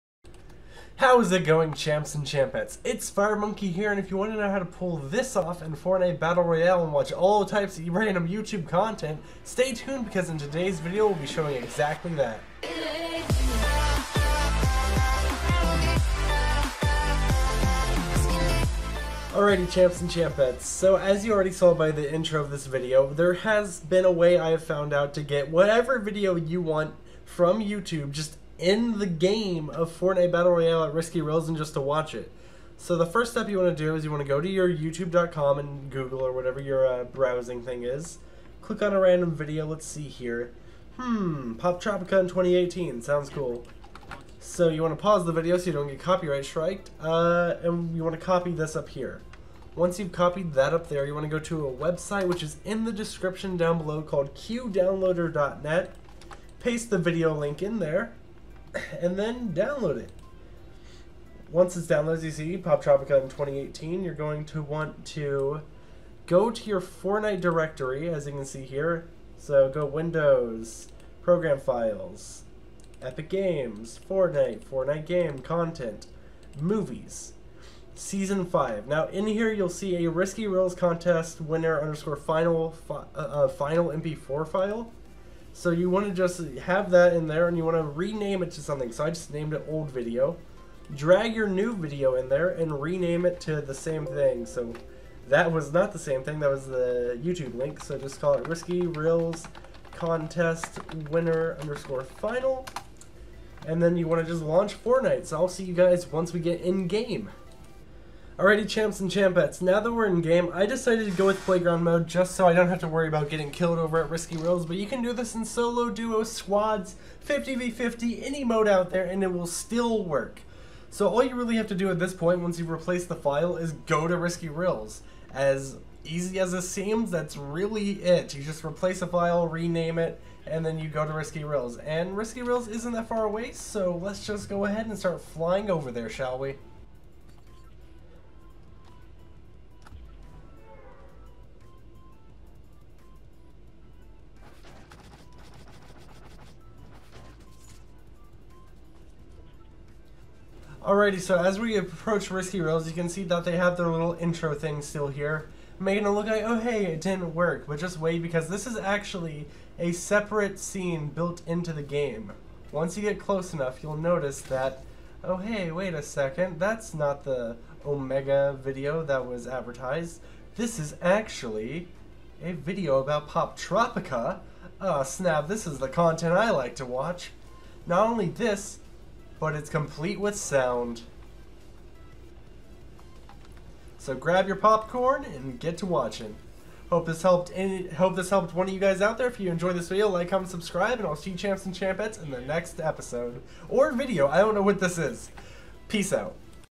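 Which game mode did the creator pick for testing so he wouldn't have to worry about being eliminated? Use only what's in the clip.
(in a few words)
Playground mode.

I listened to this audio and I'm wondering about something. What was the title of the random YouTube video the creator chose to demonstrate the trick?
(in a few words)
Poptropica in 2018.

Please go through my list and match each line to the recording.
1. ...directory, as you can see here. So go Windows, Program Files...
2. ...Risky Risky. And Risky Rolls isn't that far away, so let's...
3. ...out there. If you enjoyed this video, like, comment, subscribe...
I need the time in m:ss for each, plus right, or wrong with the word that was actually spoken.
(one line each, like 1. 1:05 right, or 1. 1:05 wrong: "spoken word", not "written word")
1. 1:07 right
2. 2:11 wrong: "Rolls", not "Risky"
3. 3:09 right.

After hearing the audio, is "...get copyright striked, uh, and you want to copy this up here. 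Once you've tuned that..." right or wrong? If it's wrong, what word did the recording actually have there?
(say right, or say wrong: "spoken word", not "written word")
wrong: "copied", not "tuned".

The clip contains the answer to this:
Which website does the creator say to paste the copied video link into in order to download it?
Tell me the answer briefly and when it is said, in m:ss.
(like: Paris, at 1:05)
qdownloader.net, at 0:54.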